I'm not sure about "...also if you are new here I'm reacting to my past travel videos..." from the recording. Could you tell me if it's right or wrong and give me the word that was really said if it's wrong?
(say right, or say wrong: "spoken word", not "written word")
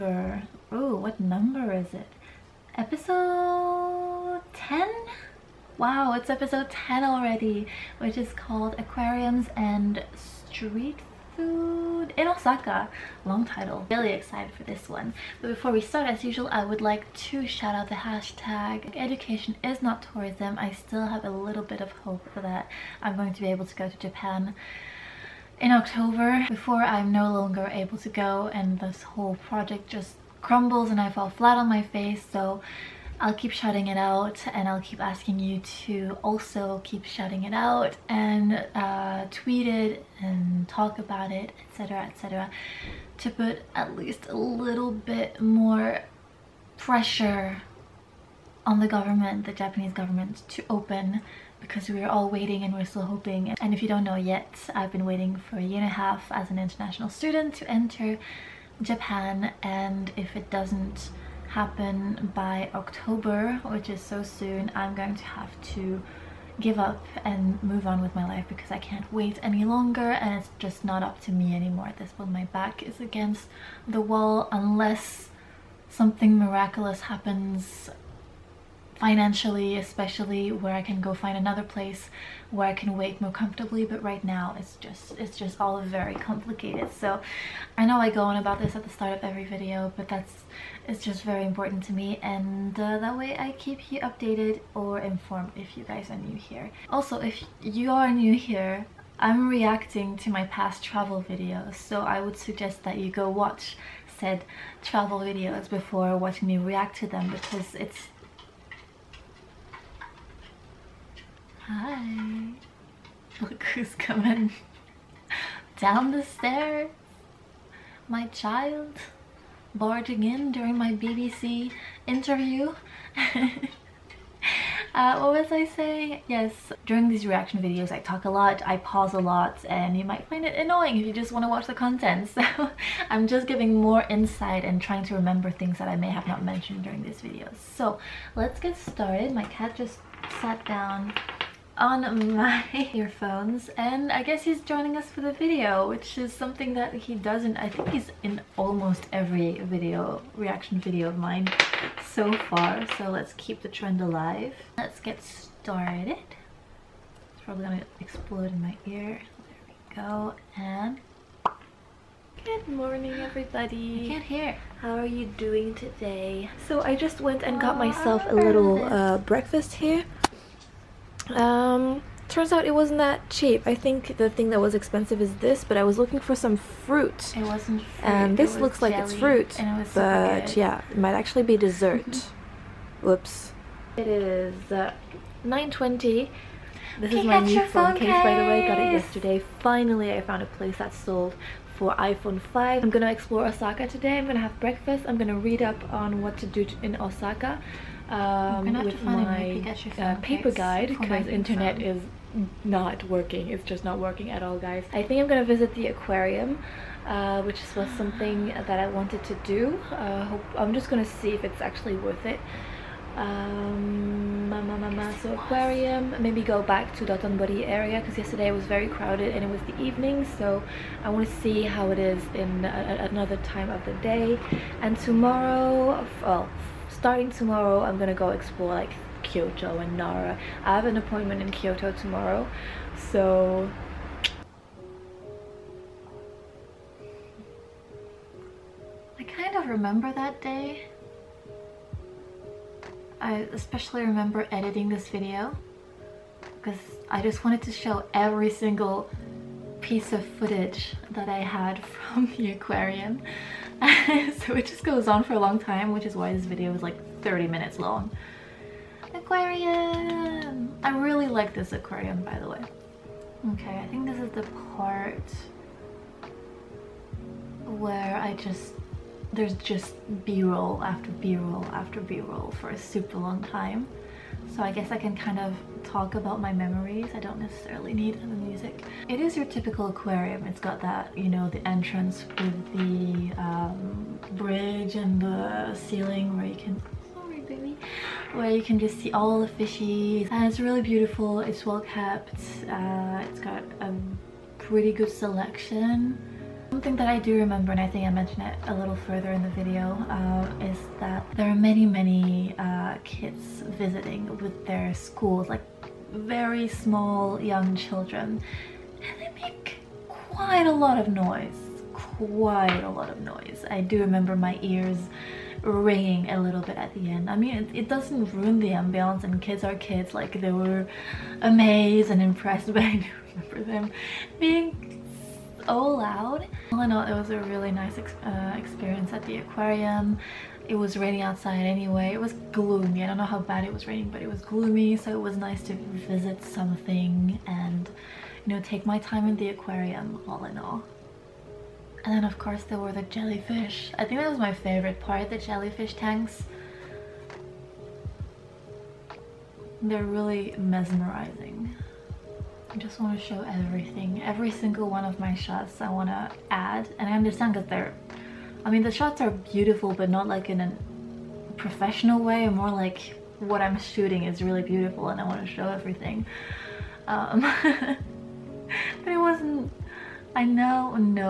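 right.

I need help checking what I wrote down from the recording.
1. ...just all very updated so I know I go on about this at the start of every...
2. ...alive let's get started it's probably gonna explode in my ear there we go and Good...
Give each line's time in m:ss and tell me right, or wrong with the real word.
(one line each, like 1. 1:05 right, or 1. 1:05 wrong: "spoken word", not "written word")
1. 1:25 wrong: "complicated", not "updated"
2. 2:34 right.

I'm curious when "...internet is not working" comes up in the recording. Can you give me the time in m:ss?
3:21.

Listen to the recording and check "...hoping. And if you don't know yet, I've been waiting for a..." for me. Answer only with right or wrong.
right.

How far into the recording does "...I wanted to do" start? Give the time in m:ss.
3:28.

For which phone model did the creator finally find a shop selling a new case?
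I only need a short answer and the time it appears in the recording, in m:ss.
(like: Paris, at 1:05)
iPhone 5, at 3:11.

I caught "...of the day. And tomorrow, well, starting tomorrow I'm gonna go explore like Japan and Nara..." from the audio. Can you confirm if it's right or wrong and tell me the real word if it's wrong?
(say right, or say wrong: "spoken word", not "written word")
wrong: "Kyoto", not "Japan".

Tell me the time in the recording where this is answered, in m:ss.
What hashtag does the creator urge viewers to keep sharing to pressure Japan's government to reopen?
0:18.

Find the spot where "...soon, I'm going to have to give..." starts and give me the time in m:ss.
1:04.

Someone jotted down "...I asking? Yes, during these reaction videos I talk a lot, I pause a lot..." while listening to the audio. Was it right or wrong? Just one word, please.
wrong.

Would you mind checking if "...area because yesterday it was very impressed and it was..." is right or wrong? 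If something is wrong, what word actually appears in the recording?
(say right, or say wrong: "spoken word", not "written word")
wrong: "crowded", not "impressed".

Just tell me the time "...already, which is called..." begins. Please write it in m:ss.
0:07.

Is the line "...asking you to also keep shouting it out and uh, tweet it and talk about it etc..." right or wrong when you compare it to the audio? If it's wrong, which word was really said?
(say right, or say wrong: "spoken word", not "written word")
right.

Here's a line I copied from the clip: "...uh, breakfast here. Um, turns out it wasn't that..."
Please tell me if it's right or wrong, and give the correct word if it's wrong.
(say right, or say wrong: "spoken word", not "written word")
right.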